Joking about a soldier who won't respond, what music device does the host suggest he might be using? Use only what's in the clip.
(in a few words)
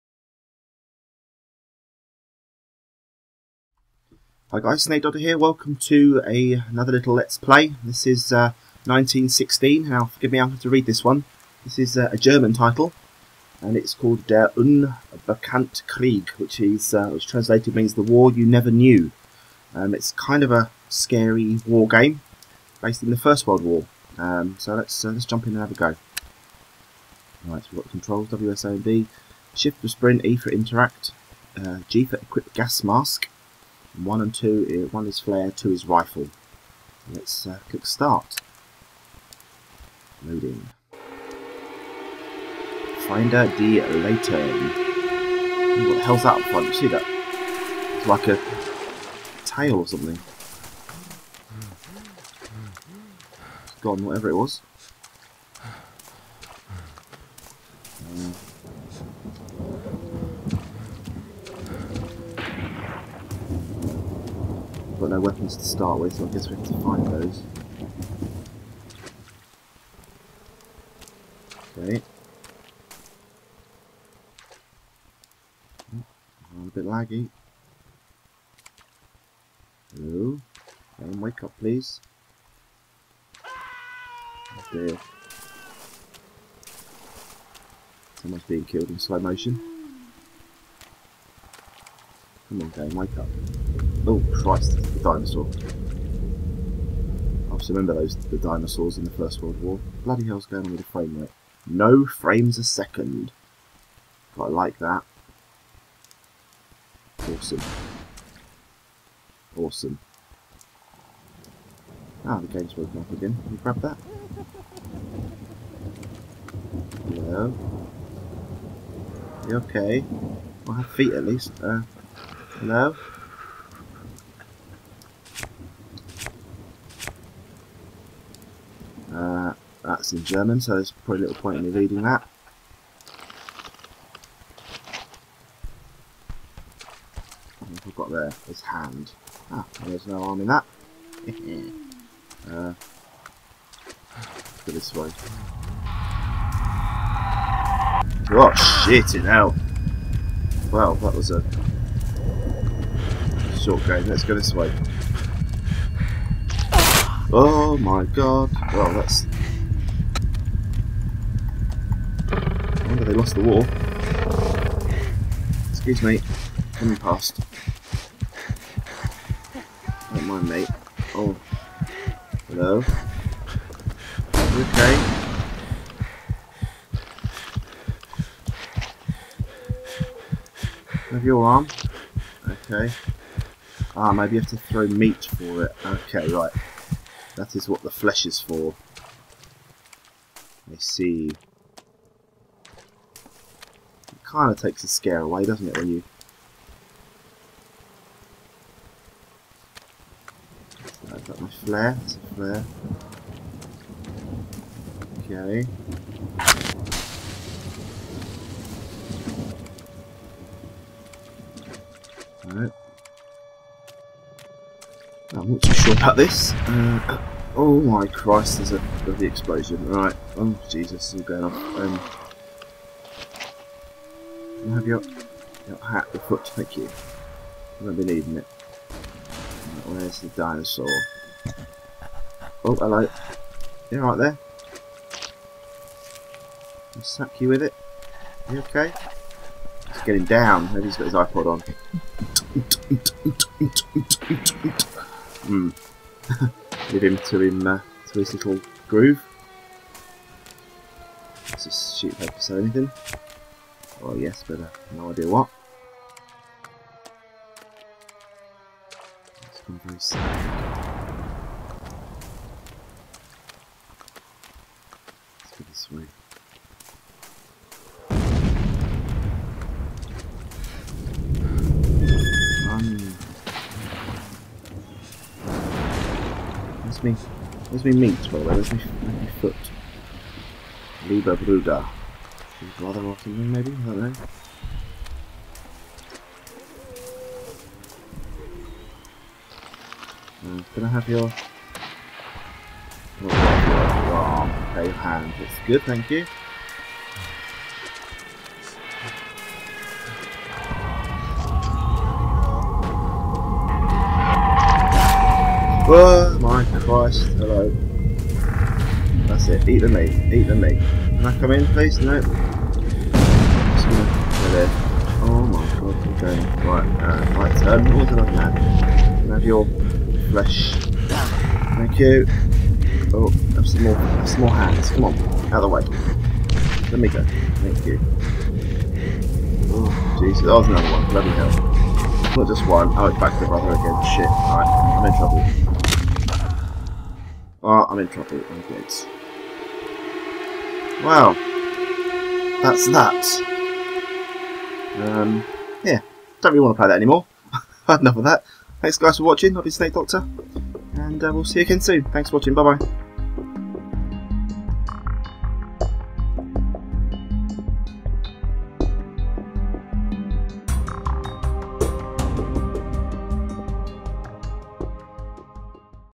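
iPod.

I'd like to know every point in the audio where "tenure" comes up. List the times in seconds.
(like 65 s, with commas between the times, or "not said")
not said.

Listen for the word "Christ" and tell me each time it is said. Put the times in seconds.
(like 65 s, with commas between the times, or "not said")
94 s, 218 s, 306 s.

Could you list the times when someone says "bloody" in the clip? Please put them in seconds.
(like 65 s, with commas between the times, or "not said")
100 s, 219 s, 331 s.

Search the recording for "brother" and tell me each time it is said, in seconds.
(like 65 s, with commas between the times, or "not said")
282 s, 333 s.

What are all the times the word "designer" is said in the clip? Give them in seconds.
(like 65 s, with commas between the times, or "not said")
not said.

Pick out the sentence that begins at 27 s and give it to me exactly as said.
All right, so we've got controls: WSA and B, Shift for sprint, E for interact, uh, G for equip gas mask.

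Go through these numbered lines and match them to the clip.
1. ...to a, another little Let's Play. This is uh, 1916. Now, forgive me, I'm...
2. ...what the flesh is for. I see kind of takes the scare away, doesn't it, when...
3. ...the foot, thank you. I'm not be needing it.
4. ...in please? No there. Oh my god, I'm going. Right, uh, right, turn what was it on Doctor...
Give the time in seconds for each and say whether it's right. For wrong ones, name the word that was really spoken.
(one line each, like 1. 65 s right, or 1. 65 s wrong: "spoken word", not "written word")
1. 5 s right
2. 187 s right
3. 226 s right
4. 311 s wrong: "Can", not "Doctor".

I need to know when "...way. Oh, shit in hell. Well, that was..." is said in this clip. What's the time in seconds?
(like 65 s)
144 s.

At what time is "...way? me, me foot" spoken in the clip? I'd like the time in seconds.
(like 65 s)
278 s.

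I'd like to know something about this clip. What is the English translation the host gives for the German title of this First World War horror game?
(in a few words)
The war you never knew.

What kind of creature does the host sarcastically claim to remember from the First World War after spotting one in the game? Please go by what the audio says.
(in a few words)
Dinosaurs.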